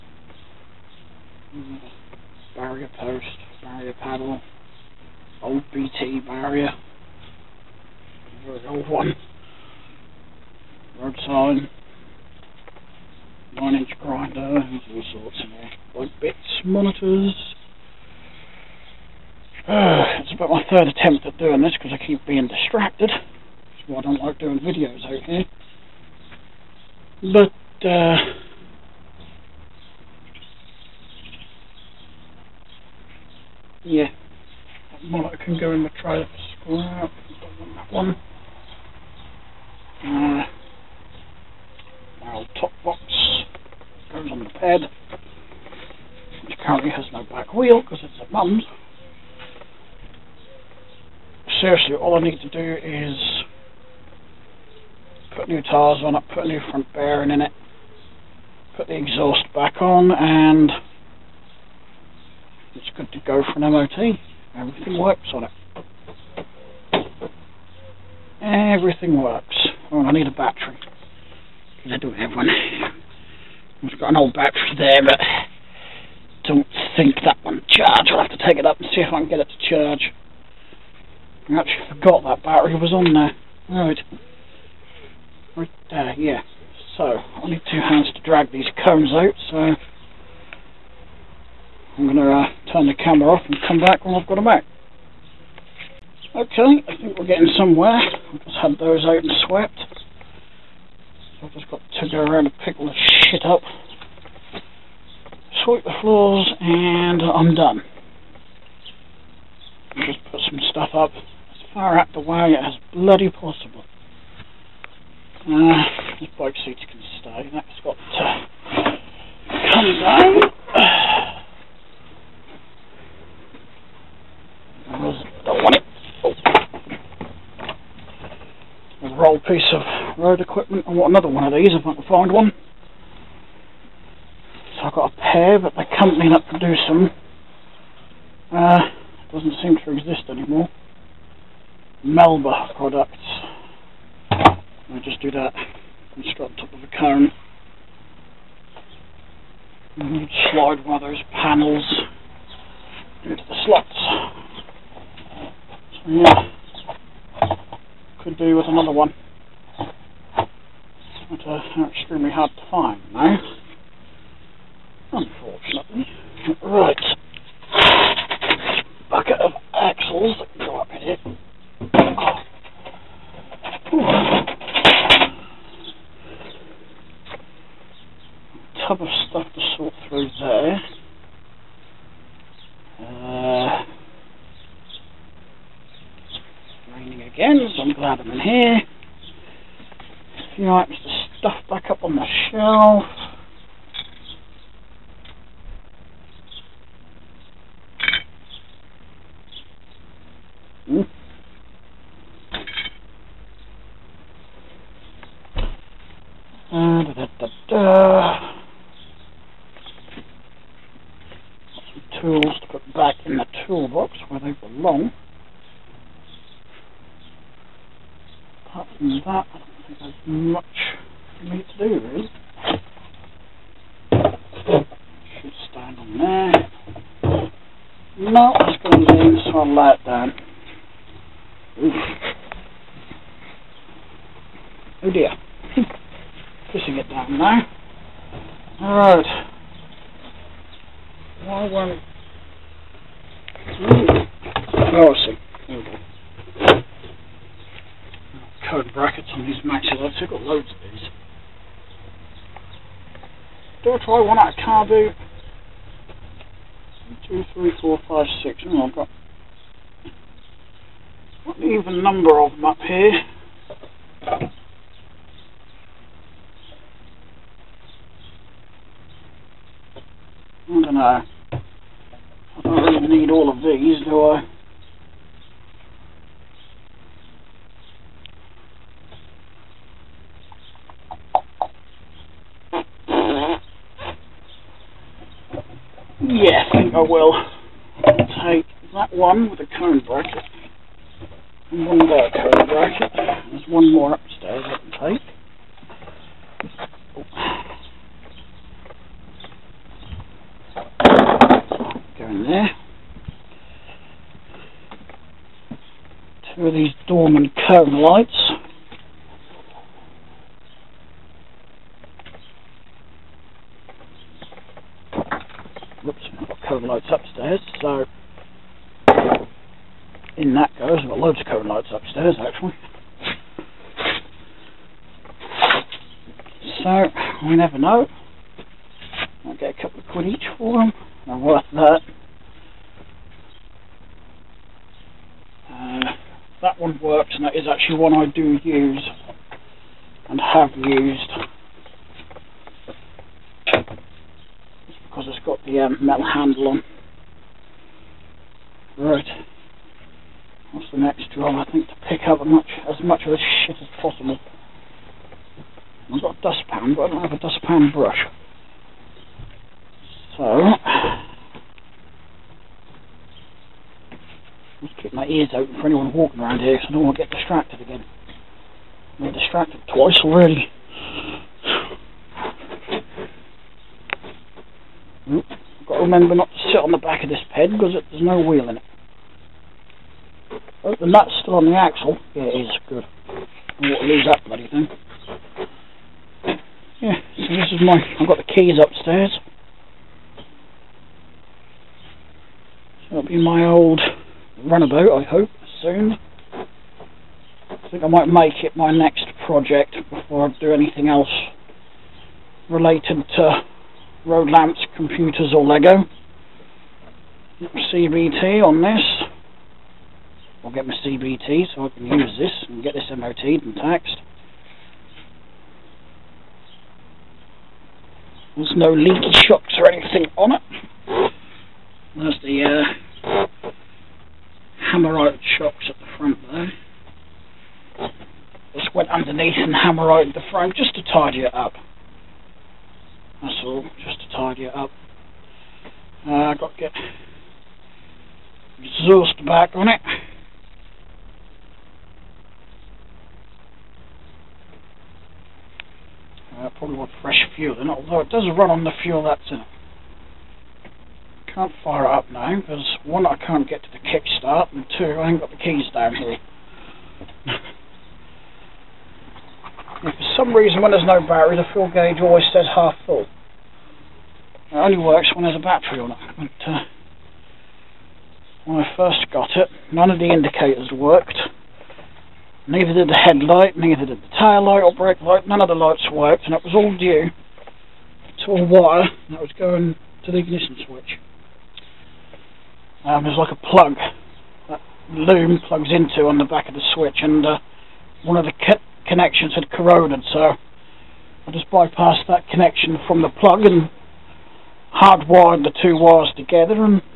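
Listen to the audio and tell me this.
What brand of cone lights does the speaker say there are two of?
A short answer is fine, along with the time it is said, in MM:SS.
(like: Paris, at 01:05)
Dorman, at 05:07.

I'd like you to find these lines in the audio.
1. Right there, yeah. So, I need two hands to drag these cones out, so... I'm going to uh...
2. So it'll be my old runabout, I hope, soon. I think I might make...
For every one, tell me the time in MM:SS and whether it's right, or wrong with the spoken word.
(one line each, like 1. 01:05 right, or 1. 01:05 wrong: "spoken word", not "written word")
1. 01:25 right
2. 06:33 right.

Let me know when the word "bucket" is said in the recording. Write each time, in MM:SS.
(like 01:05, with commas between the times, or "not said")
02:49.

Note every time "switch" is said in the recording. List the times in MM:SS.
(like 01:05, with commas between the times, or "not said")
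08:00, 08:06.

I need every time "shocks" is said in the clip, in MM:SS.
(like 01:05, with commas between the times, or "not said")
06:59, 07:05.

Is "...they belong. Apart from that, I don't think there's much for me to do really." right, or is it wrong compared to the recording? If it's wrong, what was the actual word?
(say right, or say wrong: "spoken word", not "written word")
right.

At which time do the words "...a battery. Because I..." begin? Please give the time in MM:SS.
01:10.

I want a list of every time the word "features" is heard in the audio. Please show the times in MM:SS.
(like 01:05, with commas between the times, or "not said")
not said.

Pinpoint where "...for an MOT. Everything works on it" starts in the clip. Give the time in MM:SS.
01:03.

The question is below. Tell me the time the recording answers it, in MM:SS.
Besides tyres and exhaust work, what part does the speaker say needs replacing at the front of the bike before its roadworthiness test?
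00:56.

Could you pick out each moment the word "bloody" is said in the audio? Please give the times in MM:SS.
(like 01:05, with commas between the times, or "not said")
01:52, 06:24.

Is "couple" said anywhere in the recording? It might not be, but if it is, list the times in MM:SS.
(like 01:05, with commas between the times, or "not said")
05:29.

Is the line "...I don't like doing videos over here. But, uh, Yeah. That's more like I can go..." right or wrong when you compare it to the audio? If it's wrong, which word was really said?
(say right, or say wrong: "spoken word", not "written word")
right.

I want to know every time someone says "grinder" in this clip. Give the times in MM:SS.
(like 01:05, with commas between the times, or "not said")
00:14.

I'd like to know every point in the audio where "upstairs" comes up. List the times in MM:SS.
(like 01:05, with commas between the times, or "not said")
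04:54, 06:28.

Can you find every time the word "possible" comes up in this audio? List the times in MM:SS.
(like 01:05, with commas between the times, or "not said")
01:53, 05:54.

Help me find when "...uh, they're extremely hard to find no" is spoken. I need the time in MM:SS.
02:41.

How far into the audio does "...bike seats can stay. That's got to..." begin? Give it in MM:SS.
01:56.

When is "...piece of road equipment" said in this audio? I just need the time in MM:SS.
02:09.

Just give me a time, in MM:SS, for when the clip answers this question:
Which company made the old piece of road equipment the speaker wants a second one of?
02:22.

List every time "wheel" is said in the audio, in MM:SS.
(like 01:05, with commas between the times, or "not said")
00:47, 06:18.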